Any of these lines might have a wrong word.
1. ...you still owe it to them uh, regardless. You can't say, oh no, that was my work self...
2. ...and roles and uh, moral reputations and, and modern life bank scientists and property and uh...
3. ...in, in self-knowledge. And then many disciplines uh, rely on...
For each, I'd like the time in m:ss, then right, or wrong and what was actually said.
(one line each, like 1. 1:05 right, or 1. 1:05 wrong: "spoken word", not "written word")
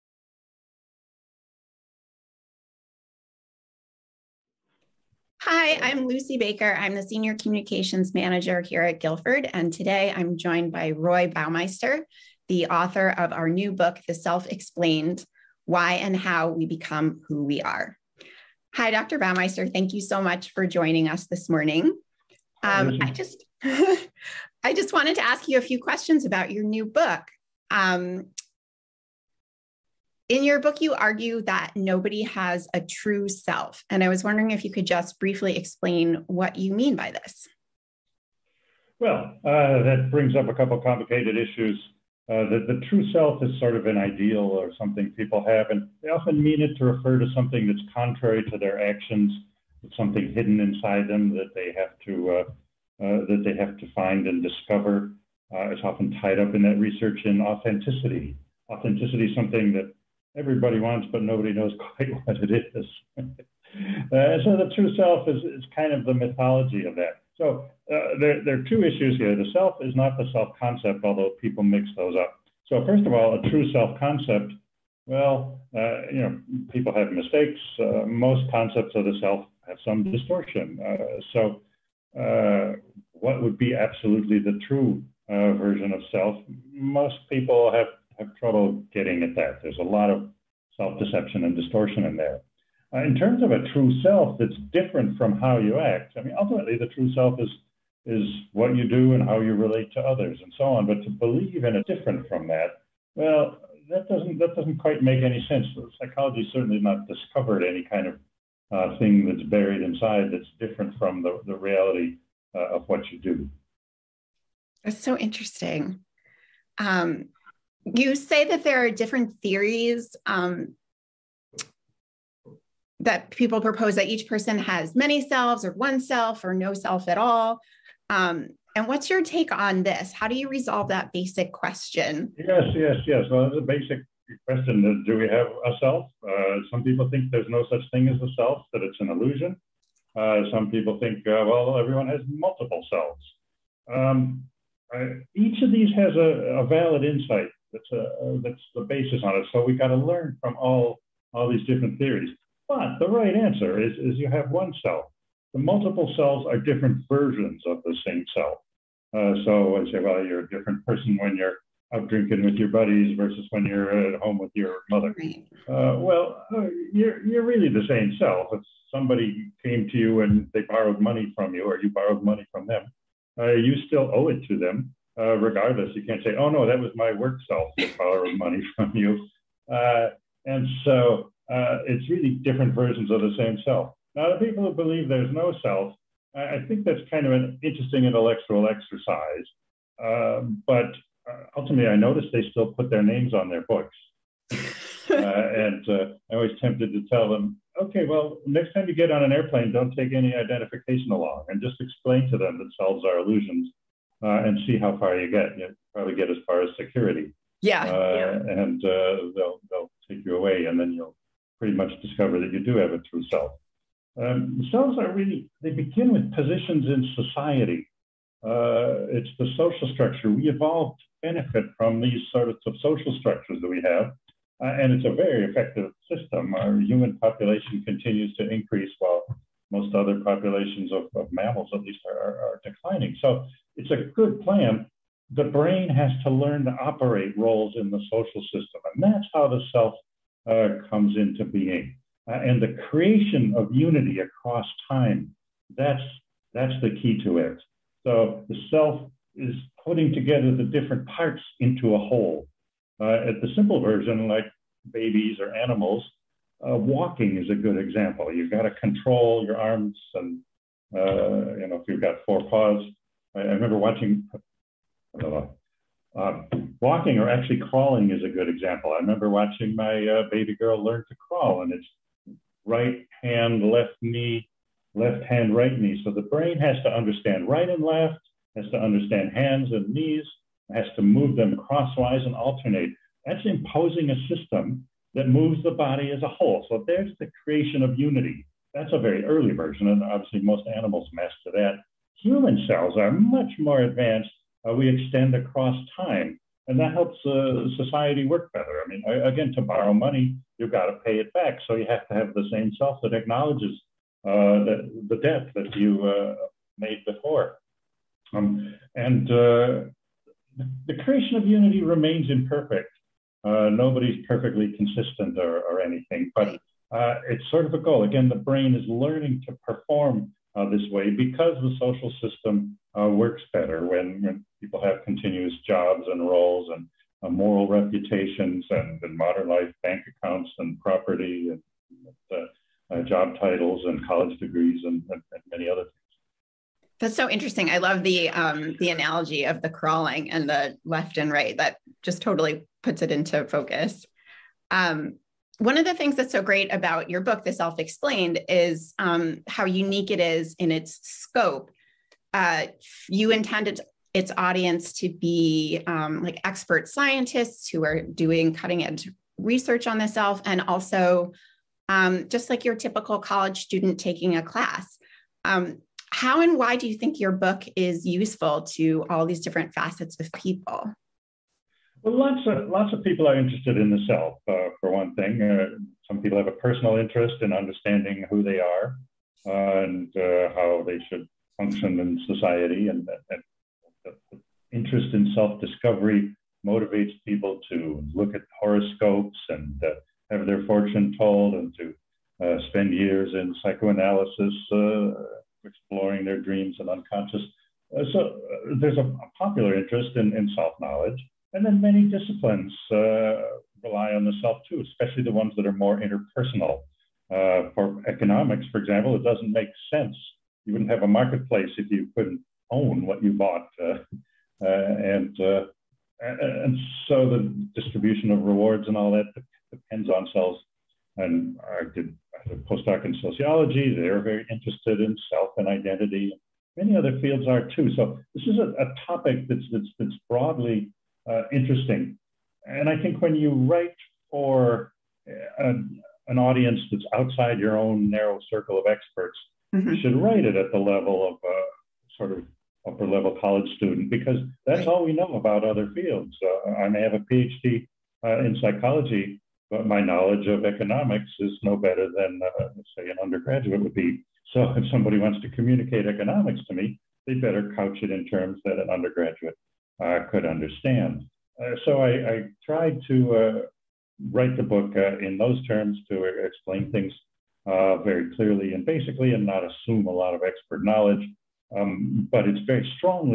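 1. 2:53 right
2. 5:26 wrong: "accounts", not "scientists"
3. 6:40 right.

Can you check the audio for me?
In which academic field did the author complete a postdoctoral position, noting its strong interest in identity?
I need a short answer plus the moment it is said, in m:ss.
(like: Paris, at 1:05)
Sociology, at 7:03.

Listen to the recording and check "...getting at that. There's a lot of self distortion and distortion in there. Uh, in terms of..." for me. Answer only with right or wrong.
wrong.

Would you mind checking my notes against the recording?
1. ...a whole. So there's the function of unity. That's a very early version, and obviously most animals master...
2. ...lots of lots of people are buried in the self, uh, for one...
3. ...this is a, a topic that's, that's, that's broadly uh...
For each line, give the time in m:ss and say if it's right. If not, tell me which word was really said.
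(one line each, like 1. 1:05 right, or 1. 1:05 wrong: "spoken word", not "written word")
1. 4:46 wrong: "creation", not "function"
2. 6:12 wrong: "interested", not "buried"
3. 7:08 right.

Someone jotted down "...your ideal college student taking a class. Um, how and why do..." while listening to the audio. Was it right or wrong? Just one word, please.
wrong.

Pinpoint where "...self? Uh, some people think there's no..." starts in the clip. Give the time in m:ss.
2:15.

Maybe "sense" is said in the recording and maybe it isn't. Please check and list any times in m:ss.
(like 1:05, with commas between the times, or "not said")
1:45, 6:49.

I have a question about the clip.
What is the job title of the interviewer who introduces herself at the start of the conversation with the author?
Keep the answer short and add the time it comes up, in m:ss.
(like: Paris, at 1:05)
Senior Communications Manager, at 0:07.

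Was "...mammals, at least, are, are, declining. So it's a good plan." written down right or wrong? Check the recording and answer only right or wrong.
right.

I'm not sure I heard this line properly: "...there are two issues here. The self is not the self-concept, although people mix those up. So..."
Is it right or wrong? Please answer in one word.
right.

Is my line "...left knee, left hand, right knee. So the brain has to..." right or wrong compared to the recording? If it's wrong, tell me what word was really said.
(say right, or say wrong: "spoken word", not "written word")
right.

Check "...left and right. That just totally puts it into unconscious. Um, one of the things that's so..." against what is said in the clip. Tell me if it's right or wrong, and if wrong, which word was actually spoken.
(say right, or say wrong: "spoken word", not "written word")
wrong: "focus", not "unconscious".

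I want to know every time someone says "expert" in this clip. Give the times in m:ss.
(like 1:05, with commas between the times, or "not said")
5:56, 7:18, 7:50.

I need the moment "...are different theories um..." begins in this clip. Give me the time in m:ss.
1:58.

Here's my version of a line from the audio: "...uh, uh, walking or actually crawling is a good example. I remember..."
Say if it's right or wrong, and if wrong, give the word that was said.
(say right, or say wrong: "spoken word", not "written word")
right.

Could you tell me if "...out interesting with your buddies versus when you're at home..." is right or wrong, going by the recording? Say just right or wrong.
wrong.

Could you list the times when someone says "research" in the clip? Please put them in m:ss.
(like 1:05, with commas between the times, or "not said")
0:56, 5:59.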